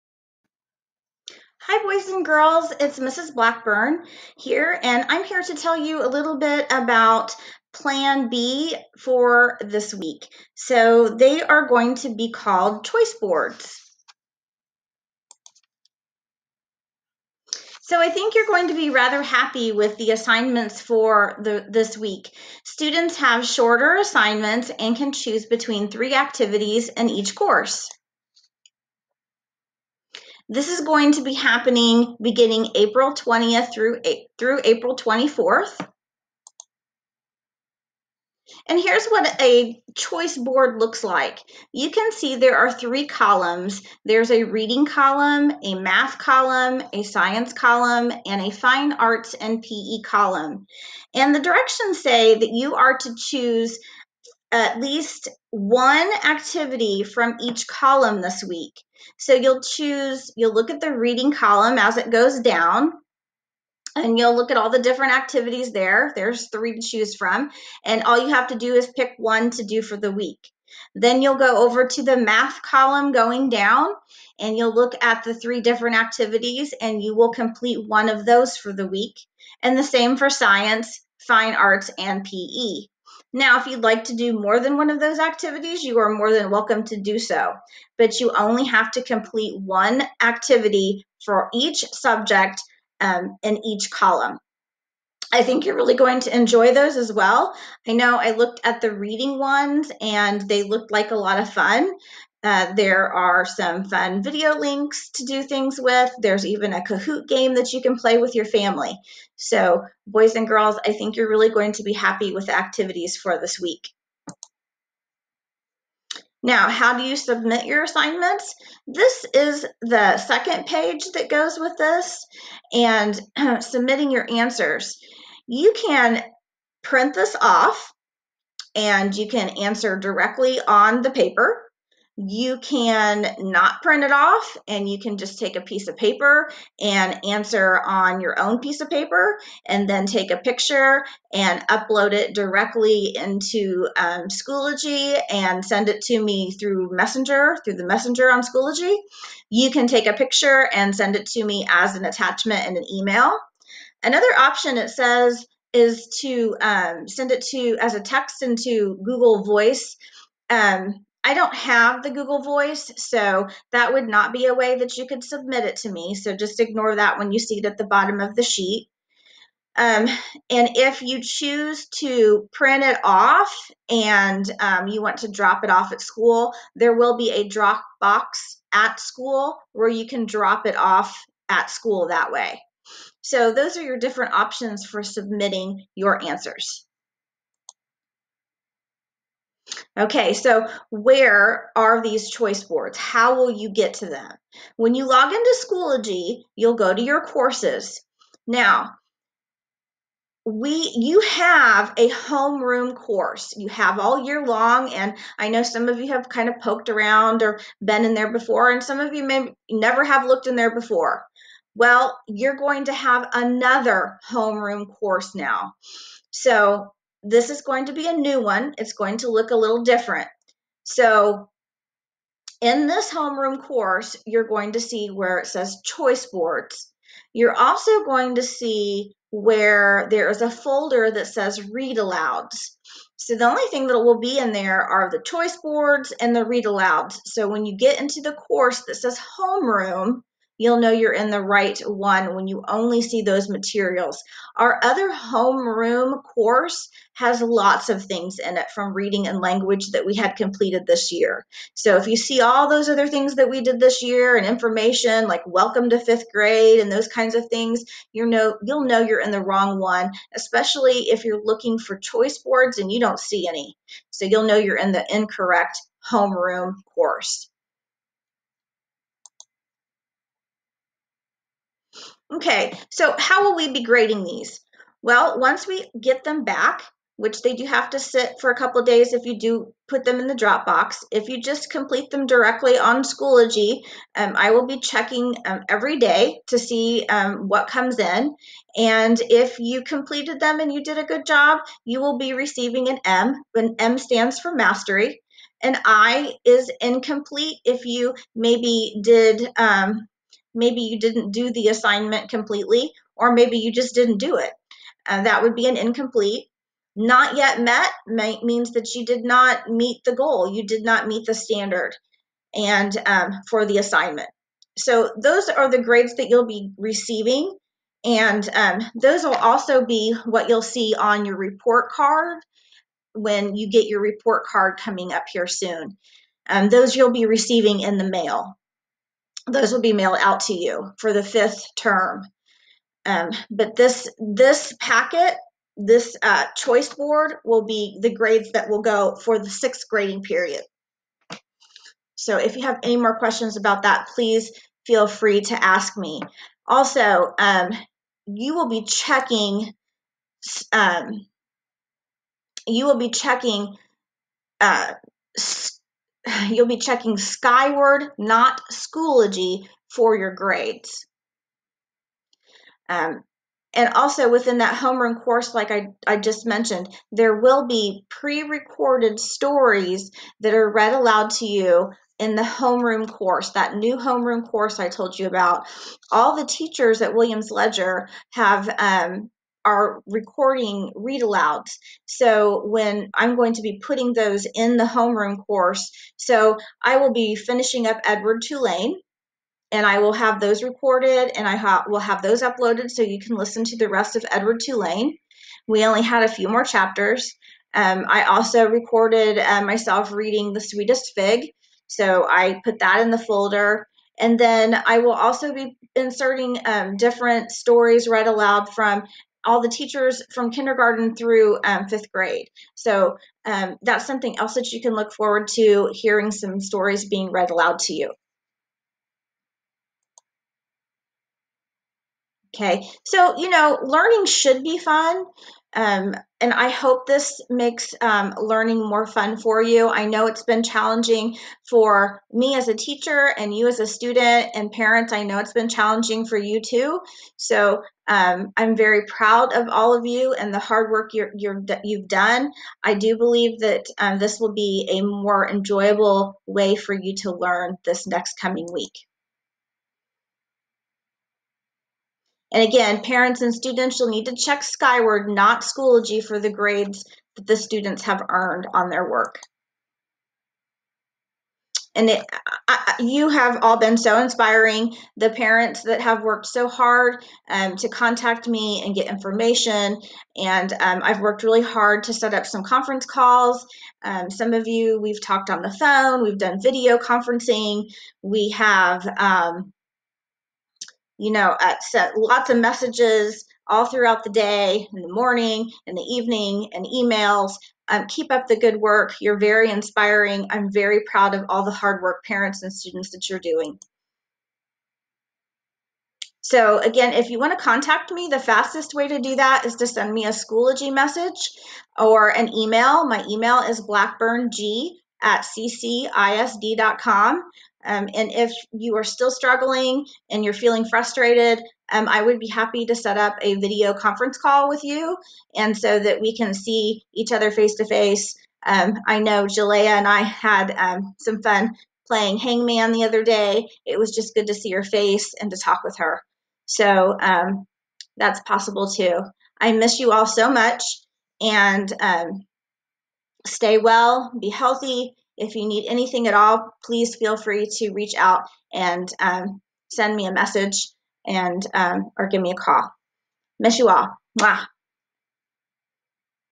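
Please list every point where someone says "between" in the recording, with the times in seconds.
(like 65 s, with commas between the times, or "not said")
25 s.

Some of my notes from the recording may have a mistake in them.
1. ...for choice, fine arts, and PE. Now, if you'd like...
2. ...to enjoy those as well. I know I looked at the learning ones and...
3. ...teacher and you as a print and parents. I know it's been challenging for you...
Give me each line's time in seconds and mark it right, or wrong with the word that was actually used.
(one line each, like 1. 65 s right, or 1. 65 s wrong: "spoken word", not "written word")
1. 80 s wrong: "science", not "choice"
2. 96 s wrong: "reading", not "learning"
3. 432 s wrong: "student", not "print".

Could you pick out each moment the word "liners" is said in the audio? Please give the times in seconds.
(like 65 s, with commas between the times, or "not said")
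not said.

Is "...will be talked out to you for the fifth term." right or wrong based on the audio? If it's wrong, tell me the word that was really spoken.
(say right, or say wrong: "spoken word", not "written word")
wrong: "mailed", not "talked".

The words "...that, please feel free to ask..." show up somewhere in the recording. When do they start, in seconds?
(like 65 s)
343 s.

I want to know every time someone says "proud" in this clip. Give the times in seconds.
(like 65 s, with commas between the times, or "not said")
439 s, 491 s.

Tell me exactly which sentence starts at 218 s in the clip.
It's going to look a little different.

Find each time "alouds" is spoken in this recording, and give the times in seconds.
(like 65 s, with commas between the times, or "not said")
231 s, 236 s, 370 s, 381 s, 408 s, 417 s.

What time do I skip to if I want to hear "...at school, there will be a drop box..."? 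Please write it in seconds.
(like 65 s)
175 s.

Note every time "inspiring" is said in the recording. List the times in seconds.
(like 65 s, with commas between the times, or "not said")
464 s, 489 s.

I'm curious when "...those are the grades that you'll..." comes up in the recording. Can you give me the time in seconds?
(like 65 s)
315 s.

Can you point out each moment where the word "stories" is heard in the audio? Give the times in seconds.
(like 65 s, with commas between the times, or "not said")
369 s, 407 s, 416 s.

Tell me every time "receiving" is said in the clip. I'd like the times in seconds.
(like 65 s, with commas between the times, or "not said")
292 s, 316 s, 327 s.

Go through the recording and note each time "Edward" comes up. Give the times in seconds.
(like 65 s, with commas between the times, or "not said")
388 s, 394 s.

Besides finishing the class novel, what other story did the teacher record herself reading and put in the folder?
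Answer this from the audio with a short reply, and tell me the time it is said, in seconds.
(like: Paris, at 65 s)
The Sweetest Fig, at 400 s.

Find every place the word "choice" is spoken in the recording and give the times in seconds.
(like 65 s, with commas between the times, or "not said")
12 s, 39 s, 192 s, 225 s, 235 s, 261 s, 336 s.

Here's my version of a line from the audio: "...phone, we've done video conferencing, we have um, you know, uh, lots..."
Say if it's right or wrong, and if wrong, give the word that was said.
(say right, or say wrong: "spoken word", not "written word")
right.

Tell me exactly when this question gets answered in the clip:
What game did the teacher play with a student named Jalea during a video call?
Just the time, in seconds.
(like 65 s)
522 s.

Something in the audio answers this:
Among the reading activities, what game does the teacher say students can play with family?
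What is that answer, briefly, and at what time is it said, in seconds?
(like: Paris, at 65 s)
Kahoot, at 106 s.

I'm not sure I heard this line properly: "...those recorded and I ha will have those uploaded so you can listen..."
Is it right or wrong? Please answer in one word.
right.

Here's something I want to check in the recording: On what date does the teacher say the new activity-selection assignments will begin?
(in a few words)
April 20th.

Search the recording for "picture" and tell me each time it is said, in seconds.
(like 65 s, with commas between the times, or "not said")
140 s, 150 s.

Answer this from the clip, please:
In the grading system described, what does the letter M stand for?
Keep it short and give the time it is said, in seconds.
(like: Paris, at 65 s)
Mastery, at 294 s.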